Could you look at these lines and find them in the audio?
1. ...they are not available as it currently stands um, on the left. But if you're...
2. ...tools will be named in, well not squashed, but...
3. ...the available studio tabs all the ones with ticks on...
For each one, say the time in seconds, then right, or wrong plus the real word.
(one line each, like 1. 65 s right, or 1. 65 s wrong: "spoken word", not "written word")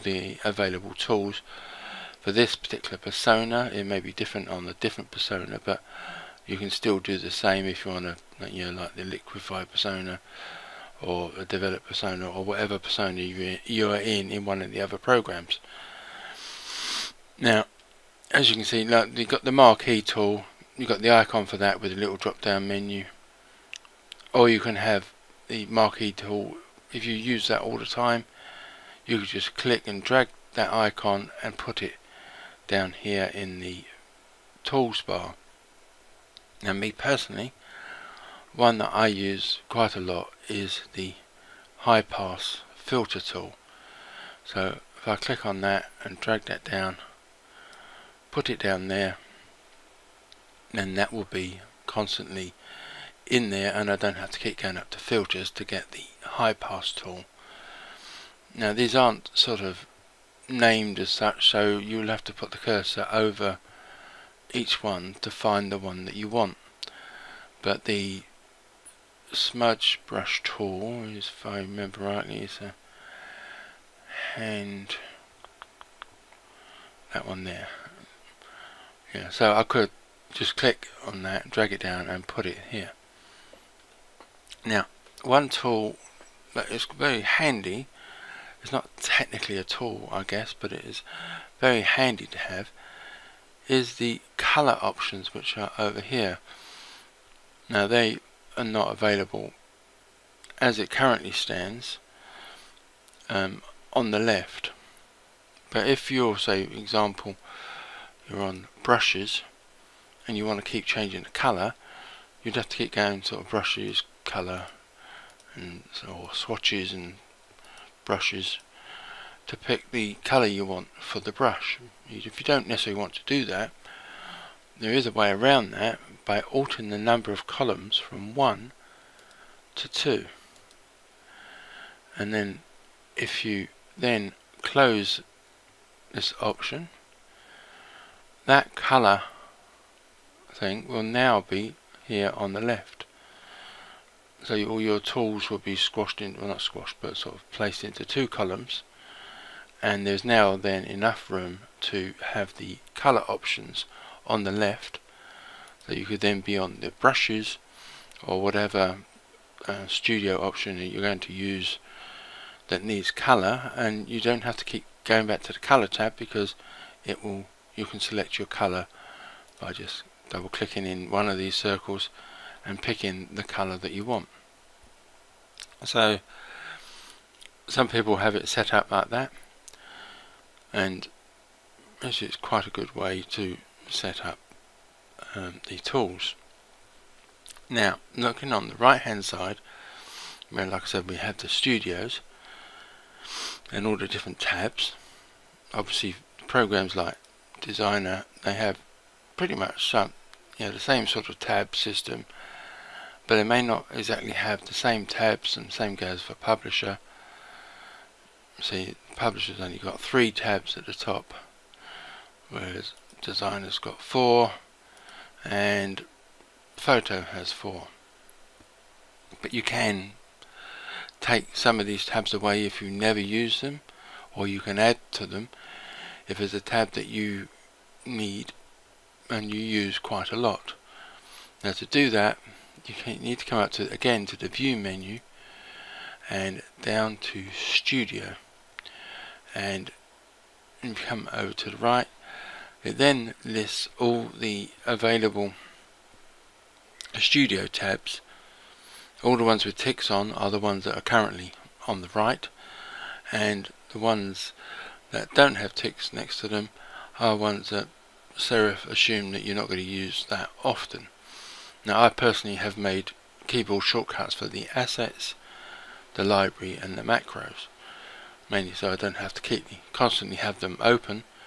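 1. 97 s right
2. 144 s wrong: "squashed", not "named"
3. 244 s right.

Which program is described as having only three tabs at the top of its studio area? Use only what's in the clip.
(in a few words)
Publisher.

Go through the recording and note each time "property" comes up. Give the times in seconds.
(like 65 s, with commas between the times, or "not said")
not said.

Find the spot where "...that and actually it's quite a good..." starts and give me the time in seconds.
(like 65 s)
179 s.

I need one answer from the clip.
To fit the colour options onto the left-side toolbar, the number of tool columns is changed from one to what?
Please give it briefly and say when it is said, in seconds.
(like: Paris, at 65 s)
2, at 129 s.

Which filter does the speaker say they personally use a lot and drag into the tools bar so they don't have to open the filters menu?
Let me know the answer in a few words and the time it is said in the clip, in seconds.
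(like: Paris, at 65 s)
High pass filter, at 41 s.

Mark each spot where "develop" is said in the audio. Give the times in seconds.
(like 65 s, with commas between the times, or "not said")
11 s.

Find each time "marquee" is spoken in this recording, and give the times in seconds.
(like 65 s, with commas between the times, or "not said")
19 s, 25 s.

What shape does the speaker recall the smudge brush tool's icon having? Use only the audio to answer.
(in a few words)
A hand.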